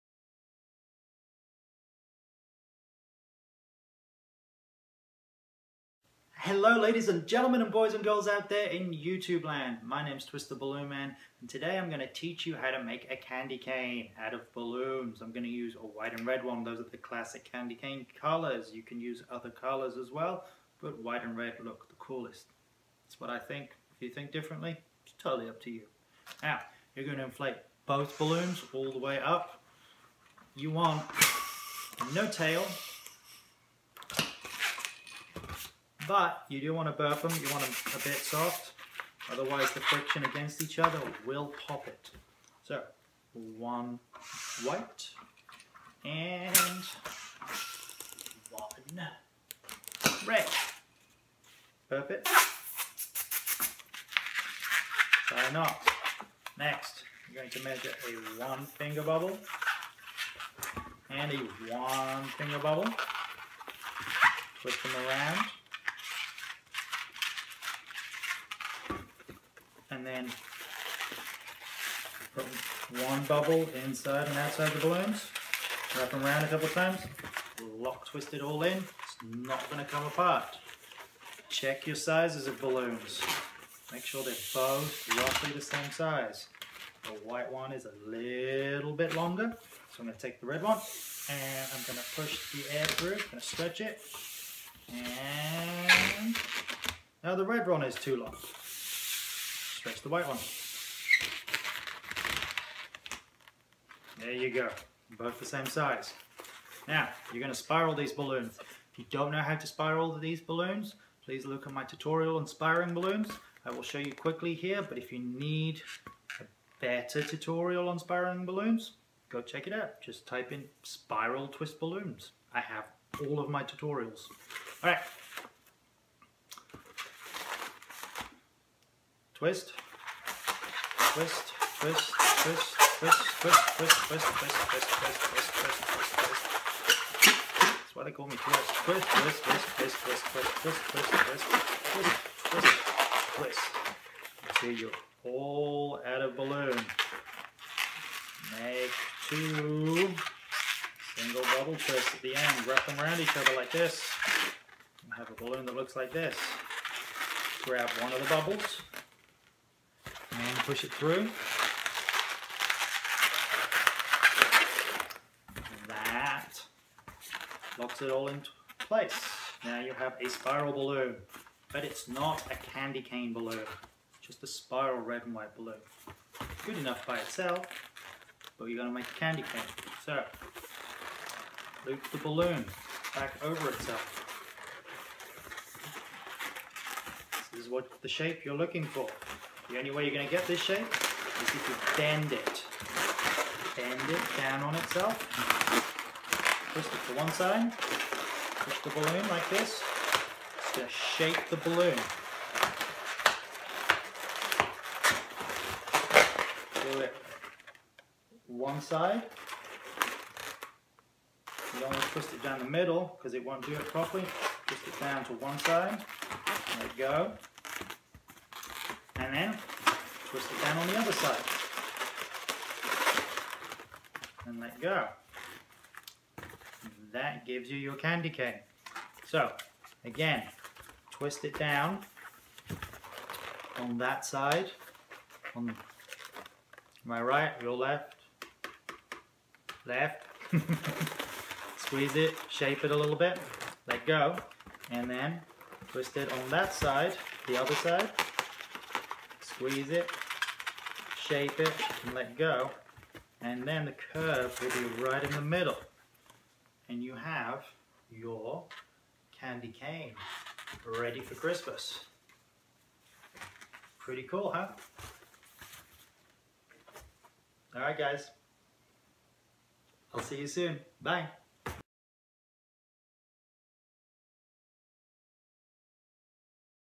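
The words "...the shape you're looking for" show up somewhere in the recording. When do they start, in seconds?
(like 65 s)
188 s.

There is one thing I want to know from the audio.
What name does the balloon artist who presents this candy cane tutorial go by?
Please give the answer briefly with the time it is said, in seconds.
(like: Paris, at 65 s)
Twist the Balloonman, at 10 s.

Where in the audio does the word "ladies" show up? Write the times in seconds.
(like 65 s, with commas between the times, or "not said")
6 s.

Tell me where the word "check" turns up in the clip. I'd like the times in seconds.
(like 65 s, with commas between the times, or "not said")
81 s, 119 s.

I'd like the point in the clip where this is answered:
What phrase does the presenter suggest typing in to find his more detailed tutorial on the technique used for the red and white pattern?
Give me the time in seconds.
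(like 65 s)
120 s.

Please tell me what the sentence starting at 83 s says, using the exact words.
Make sure they're both roughly the same size.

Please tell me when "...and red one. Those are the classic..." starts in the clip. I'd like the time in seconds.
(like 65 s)
16 s.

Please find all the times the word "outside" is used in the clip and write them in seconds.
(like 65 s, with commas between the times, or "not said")
74 s.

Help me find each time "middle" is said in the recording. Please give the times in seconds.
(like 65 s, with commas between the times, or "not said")
212 s, 255 s.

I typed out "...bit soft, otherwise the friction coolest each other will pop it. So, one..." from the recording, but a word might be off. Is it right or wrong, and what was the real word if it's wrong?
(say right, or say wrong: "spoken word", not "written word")
wrong: "against", not "coolest".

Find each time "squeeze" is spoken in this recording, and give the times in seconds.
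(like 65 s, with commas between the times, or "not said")
241 s, 249 s.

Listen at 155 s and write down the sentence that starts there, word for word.
And have a balloon that looks like this.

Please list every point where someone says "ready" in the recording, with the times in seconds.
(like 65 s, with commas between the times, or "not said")
260 s.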